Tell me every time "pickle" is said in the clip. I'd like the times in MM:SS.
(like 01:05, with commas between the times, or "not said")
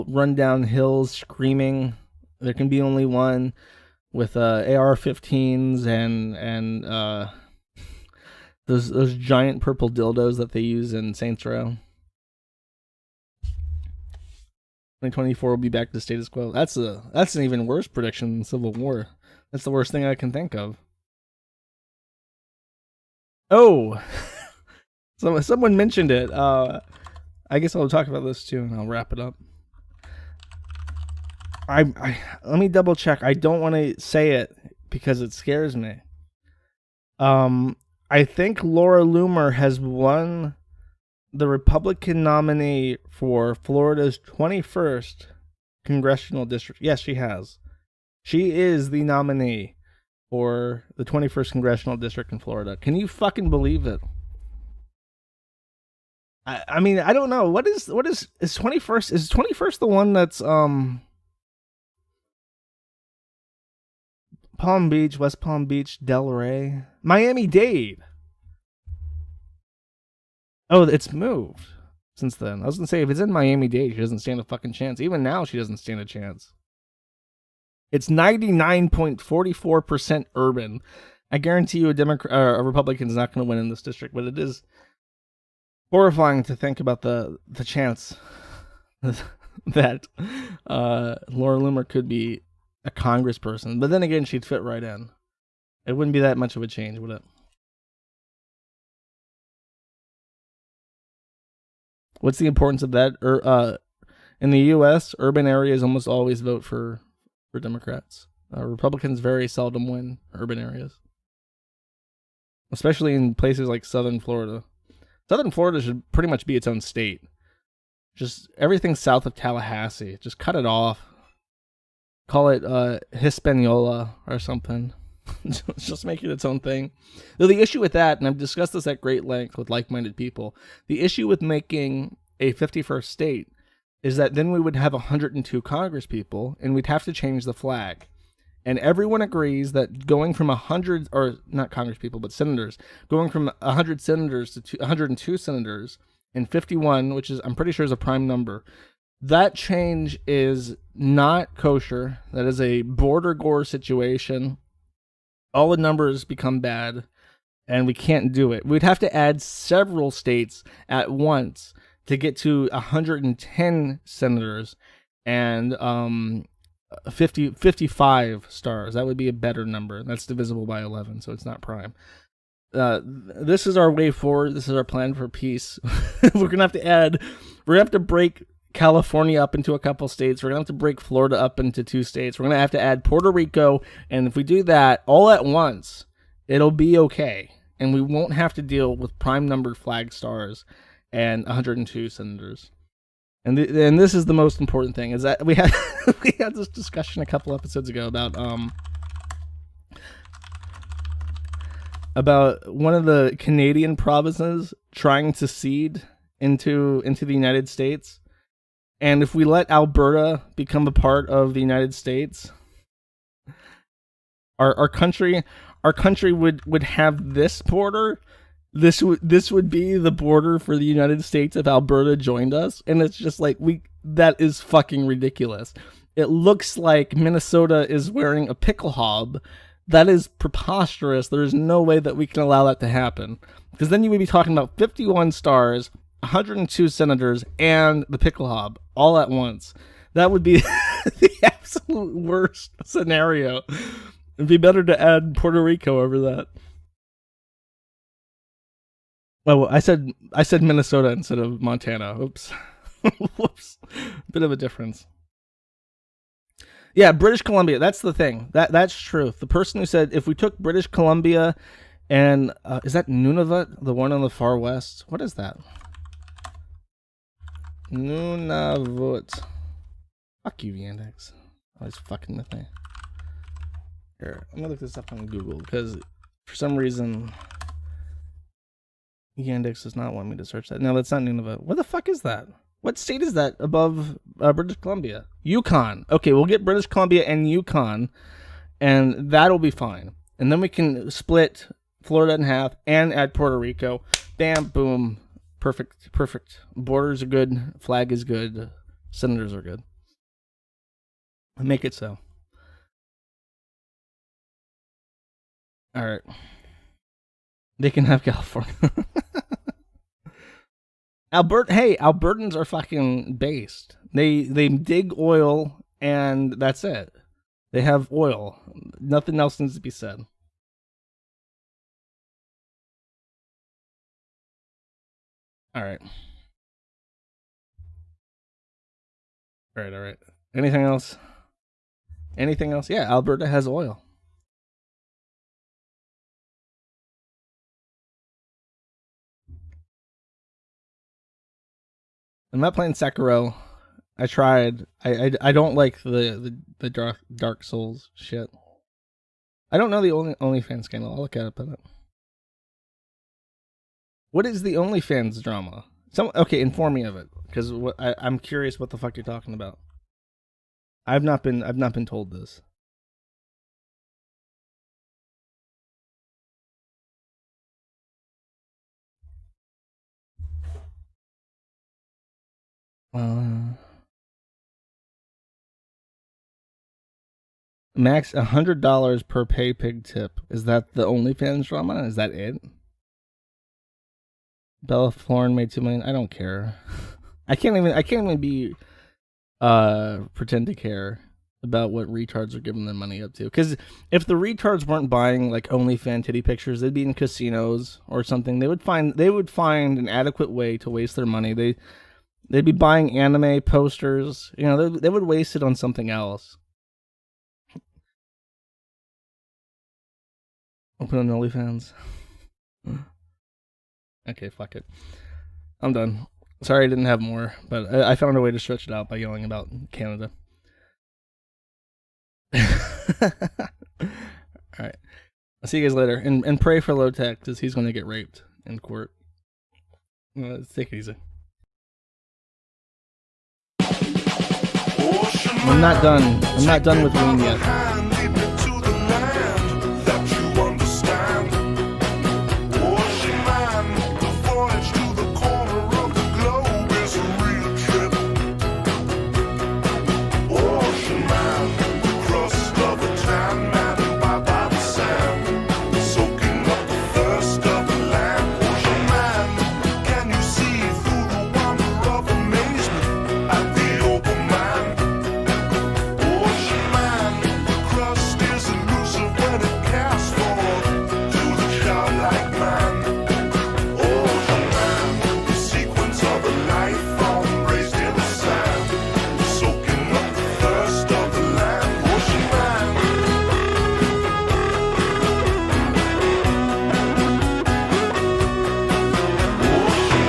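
03:48, 03:58.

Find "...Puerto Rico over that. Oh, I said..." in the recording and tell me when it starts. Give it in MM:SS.
04:05.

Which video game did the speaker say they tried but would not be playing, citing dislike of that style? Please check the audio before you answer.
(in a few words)
Sekiro.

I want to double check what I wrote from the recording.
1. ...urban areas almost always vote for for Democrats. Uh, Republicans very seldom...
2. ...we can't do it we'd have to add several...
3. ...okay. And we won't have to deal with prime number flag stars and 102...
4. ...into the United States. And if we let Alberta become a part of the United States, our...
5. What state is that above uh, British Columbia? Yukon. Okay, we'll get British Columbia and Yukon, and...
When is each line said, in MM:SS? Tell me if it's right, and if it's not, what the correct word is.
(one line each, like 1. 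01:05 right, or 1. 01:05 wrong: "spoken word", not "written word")
1. 01:45 right
2. 02:37 right
3. 03:06 right
4. 03:27 right
5. 04:42 right.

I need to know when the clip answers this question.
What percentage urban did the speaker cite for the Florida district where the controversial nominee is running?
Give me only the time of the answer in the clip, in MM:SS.
01:18.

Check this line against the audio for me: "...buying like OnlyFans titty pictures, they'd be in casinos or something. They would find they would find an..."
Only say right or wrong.
right.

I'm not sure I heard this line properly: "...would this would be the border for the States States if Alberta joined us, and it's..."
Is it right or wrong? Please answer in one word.
wrong.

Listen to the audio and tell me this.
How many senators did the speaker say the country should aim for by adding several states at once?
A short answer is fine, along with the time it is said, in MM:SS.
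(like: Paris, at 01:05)
110, at 02:42.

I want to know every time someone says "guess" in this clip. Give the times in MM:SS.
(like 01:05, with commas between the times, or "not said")
00:27.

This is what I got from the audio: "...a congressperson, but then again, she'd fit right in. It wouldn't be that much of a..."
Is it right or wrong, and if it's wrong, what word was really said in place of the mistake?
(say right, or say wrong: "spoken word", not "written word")
right.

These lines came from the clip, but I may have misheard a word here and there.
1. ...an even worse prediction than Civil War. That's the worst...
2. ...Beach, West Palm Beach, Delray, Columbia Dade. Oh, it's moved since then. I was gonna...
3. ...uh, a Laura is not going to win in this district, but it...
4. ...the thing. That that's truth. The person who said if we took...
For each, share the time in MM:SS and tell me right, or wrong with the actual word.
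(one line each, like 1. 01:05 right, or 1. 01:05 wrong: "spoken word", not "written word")
1. 00:17 right
2. 01:04 wrong: "Miami", not "Columbia"
3. 01:22 wrong: "Republican", not "Laura"
4. 04:18 right.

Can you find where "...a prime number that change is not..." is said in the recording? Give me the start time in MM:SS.
02:27.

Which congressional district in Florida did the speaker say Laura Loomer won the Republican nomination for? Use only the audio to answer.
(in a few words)
21st.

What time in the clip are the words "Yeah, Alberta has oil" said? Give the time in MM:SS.
05:32.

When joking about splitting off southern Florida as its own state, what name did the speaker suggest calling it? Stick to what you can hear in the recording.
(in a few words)
Hispaniola.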